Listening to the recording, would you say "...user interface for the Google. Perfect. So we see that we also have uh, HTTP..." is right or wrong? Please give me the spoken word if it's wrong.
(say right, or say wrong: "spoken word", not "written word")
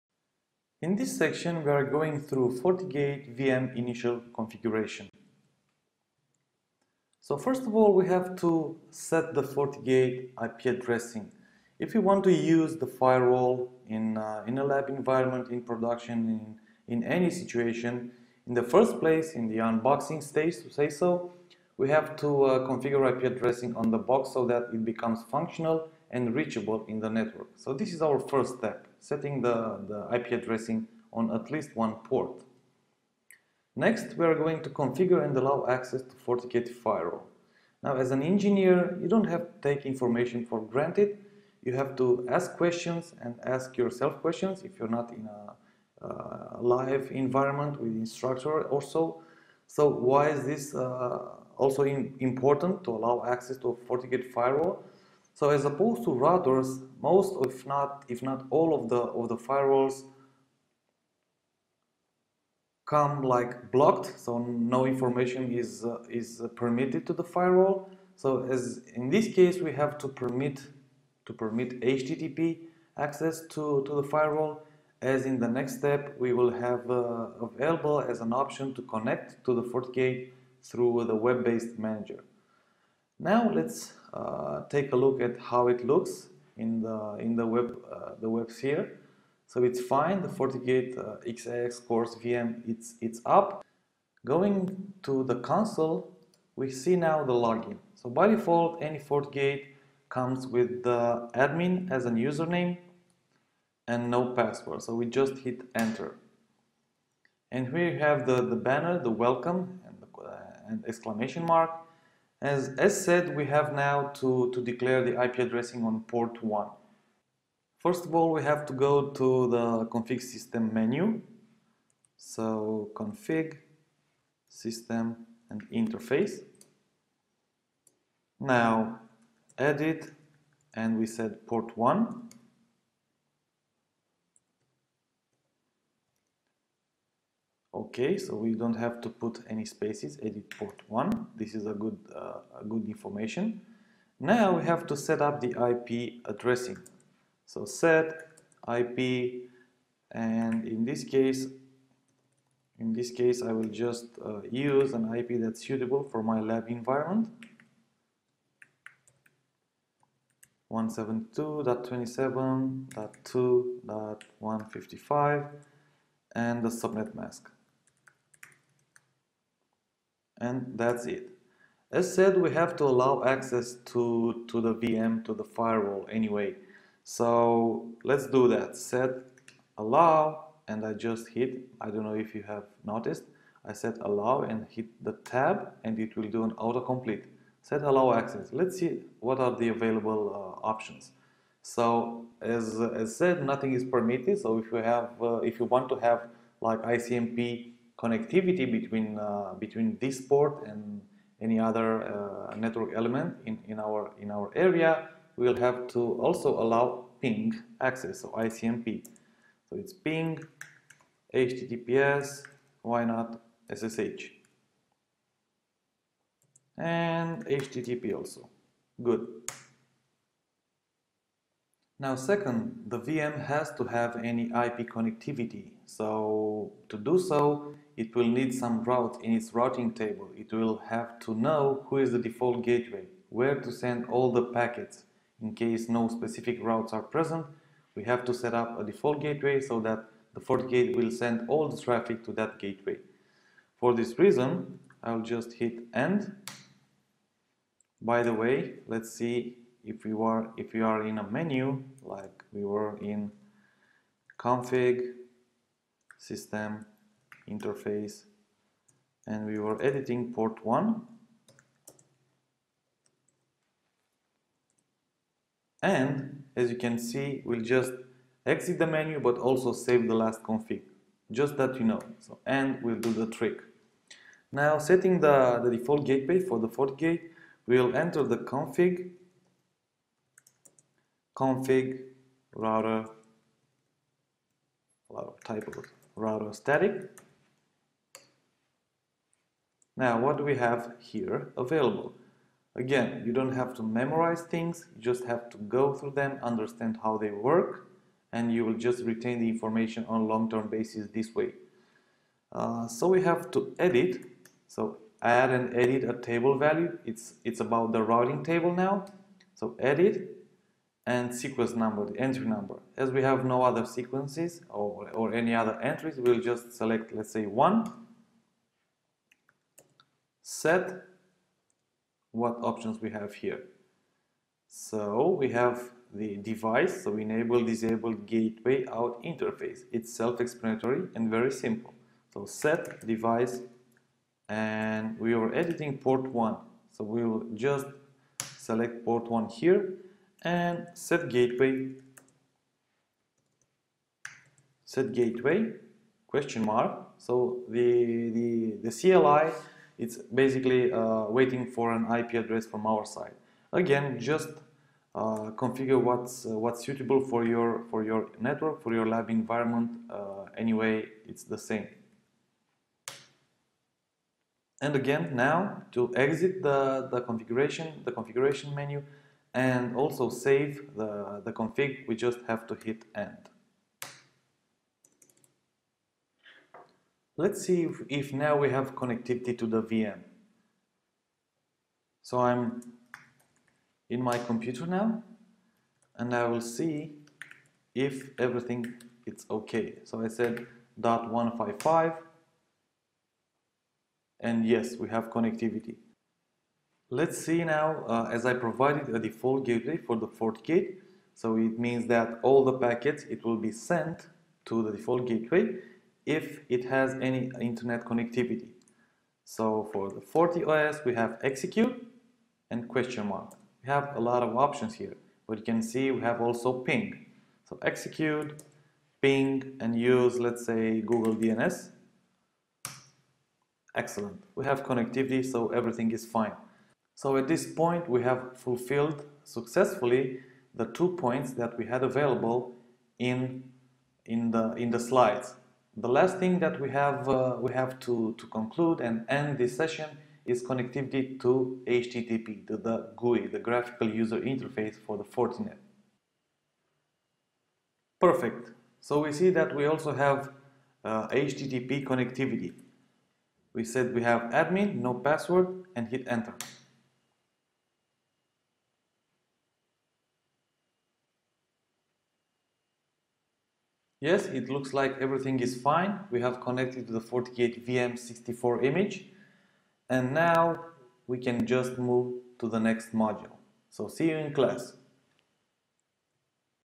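wrong: "Fortinet", not "Google".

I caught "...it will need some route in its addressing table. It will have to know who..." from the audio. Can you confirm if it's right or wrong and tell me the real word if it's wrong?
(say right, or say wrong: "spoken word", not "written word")
wrong: "routing", not "addressing".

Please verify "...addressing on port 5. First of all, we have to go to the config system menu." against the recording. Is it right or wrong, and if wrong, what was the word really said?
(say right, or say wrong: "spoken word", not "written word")
wrong: "1", not "5".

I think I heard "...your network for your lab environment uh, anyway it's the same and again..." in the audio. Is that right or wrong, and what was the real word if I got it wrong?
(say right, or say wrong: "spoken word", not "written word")
right.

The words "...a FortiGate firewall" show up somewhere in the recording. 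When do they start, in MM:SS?
00:53.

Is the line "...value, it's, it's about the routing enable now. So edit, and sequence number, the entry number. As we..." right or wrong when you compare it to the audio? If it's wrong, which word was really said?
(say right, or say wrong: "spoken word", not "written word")
wrong: "table", not "enable".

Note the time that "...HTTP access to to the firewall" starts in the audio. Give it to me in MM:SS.
01:11.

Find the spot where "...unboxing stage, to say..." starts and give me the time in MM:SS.
00:19.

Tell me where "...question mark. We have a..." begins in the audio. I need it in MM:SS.
06:52.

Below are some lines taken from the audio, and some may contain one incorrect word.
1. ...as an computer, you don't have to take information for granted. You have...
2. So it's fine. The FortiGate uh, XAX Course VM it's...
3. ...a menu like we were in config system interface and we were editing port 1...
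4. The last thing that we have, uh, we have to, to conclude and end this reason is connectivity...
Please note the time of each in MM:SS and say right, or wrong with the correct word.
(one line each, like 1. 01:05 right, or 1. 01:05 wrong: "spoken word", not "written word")
1. 00:37 wrong: "engineer", not "computer"
2. 01:29 right
3. 04:11 right
4. 07:15 wrong: "session", not "reason".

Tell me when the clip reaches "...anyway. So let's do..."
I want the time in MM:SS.
02:56.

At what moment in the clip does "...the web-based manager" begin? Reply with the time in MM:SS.
01:21.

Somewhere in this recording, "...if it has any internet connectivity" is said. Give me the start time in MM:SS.
06:46.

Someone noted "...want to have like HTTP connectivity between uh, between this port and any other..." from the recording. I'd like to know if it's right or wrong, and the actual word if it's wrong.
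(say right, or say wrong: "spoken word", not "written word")
wrong: "ICMP", not "HTTP".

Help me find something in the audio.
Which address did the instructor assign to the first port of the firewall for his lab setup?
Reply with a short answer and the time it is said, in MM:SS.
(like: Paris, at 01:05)
172.27.2.155, at 02:40.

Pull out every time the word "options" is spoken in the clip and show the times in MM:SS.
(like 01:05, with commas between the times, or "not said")
01:18, 03:10, 05:22, 06:54.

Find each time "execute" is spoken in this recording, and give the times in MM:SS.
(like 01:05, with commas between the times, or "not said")
06:51, 06:57.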